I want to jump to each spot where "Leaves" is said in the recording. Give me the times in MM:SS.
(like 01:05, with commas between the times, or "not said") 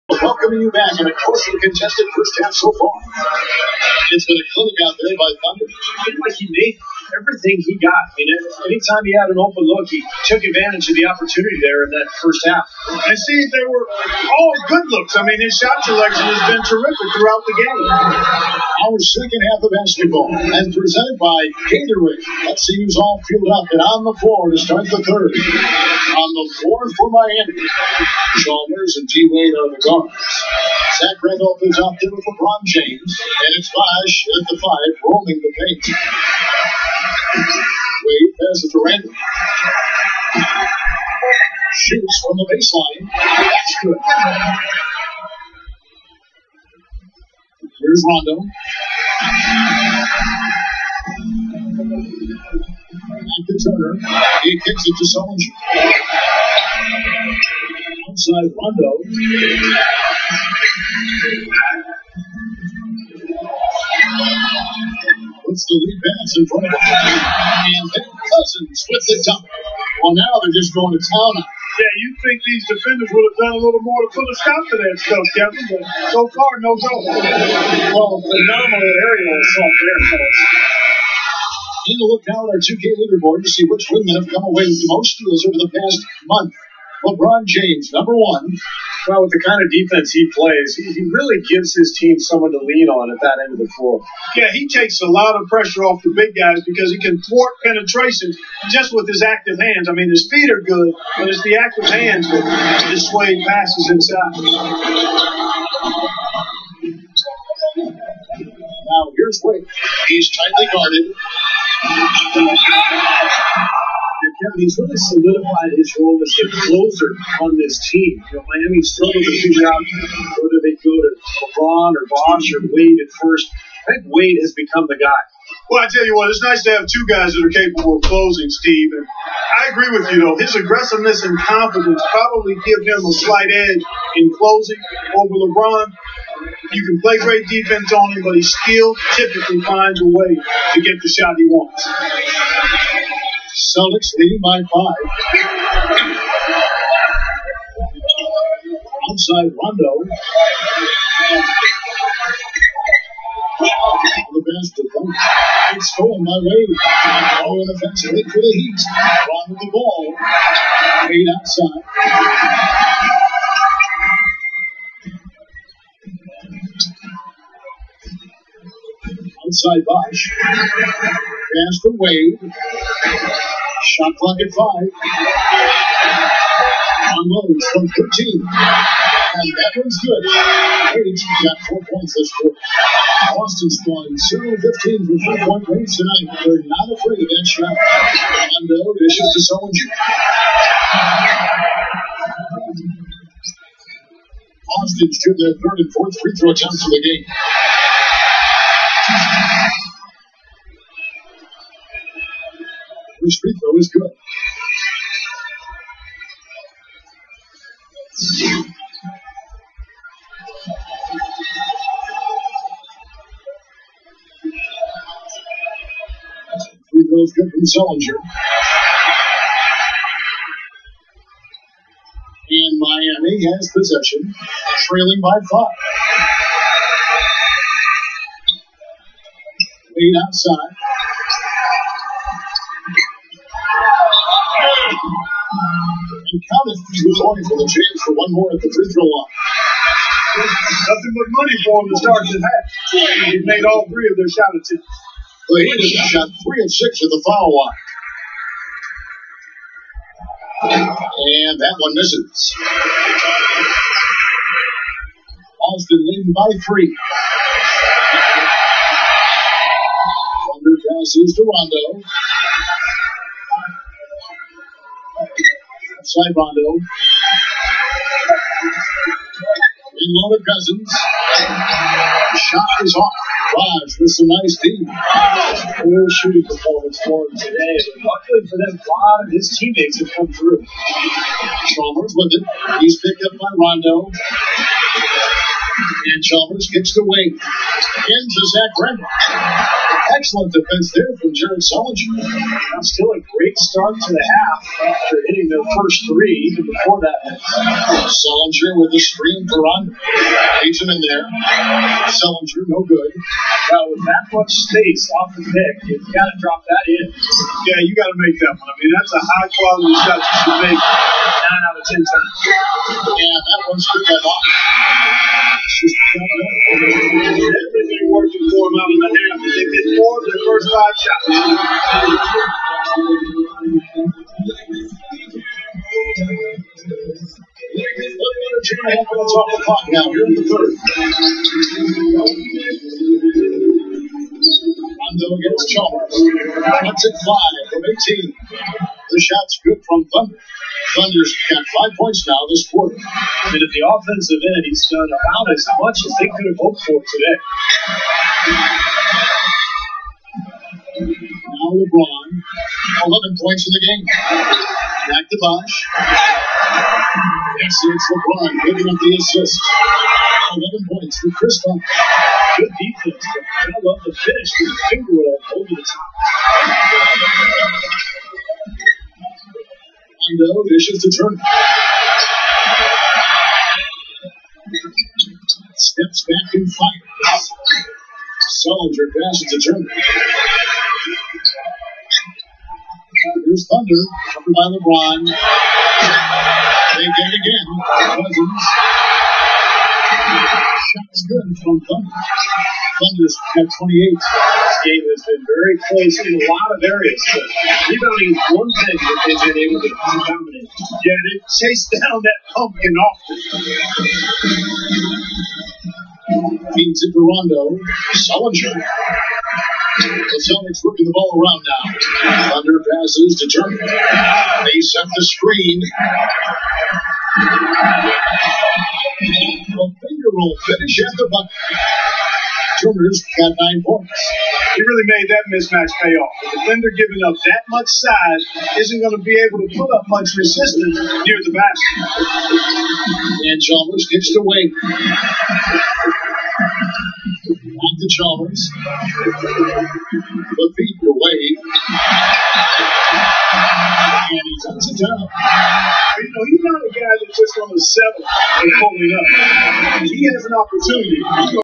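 05:00.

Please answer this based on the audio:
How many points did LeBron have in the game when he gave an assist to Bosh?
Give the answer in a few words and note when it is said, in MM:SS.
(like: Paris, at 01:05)
11, at 05:51.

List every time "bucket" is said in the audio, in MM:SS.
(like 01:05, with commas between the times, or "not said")
07:01.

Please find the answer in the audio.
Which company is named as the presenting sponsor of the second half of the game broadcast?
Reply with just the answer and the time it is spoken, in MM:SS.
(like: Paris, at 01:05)
Gatorade, at 00:21.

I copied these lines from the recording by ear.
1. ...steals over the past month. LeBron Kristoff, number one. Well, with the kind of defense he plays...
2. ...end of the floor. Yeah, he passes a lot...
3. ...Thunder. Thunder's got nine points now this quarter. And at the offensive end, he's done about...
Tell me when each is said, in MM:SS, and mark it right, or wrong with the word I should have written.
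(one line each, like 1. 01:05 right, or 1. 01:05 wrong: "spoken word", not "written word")
1. 01:25 wrong: "James", not "Kristoff"
2. 01:33 wrong: "takes", not "passes"
3. 05:40 wrong: "five", not "nine".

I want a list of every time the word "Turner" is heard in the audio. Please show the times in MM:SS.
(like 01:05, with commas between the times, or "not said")
00:53, 06:19, 06:53, 07:02.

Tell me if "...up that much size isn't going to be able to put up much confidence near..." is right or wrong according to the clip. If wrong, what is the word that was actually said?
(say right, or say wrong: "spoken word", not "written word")
wrong: "resistance", not "confidence".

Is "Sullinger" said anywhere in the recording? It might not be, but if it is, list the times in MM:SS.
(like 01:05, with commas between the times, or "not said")
00:55, 03:09, 03:37, 04:51, 04:58, 05:02, 06:18, 06:48.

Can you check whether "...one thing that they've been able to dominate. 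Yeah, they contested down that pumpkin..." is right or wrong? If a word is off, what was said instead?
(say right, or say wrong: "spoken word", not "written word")
wrong: "chased", not "contested".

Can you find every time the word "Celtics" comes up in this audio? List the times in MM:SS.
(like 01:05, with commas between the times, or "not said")
02:23, 06:50.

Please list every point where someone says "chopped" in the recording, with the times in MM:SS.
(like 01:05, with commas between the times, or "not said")
not said.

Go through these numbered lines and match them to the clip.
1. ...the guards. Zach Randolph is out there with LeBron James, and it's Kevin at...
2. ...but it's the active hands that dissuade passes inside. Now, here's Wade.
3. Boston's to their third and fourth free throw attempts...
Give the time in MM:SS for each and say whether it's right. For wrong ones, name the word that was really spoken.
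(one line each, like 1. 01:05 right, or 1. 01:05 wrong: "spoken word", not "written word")
1. 00:29 wrong: "Bosh", not "Kevin"
2. 01:41 right
3. 03:14 right.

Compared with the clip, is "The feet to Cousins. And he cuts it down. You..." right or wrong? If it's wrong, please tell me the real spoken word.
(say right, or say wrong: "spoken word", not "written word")
wrong: "Wade", not "Cousins".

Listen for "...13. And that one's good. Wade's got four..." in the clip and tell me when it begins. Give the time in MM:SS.
02:57.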